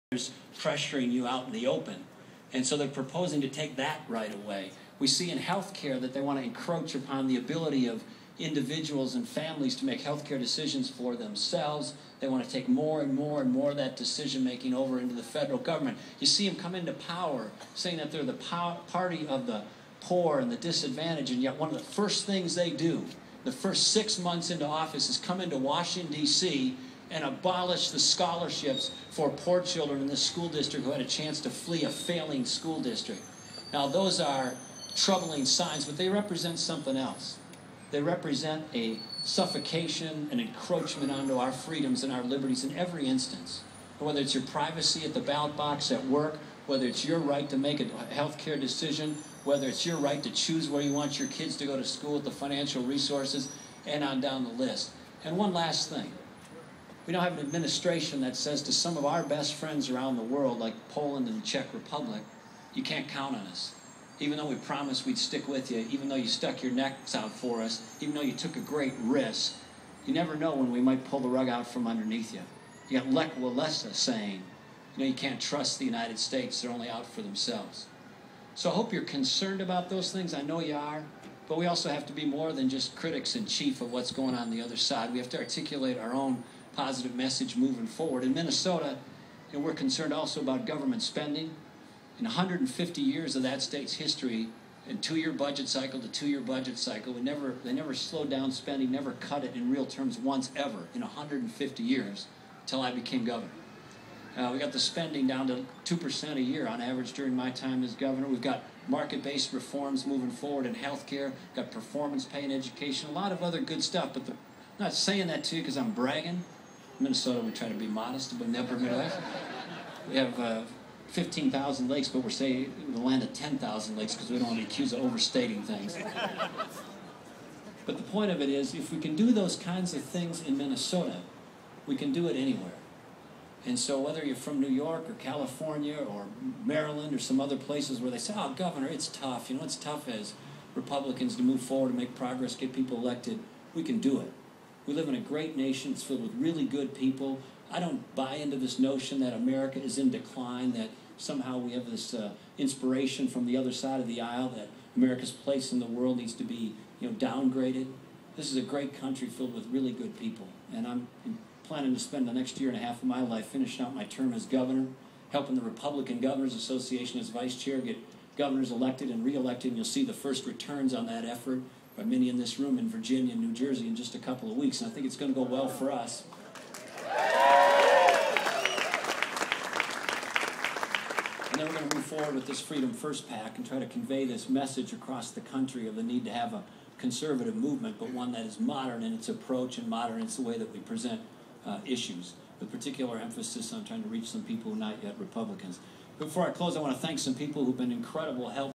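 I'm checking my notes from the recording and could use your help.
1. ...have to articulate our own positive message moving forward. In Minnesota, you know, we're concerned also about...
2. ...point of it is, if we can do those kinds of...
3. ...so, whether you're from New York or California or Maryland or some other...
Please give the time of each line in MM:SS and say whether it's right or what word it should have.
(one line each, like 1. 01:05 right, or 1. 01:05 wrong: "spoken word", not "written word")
1. 01:25 right
2. 02:08 right
3. 02:13 right.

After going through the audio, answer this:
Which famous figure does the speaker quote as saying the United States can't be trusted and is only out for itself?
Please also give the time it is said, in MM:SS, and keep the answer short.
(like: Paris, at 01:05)
Lech Walesa, at 01:13.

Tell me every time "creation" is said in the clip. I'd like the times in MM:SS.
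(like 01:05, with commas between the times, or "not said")
not said.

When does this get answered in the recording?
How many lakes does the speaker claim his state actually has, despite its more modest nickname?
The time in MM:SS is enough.
02:01.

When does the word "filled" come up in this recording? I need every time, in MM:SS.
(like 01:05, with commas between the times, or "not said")
02:26, 02:39.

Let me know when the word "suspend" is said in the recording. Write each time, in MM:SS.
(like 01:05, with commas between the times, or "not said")
not said.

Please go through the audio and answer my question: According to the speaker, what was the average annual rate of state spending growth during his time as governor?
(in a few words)
2 percent.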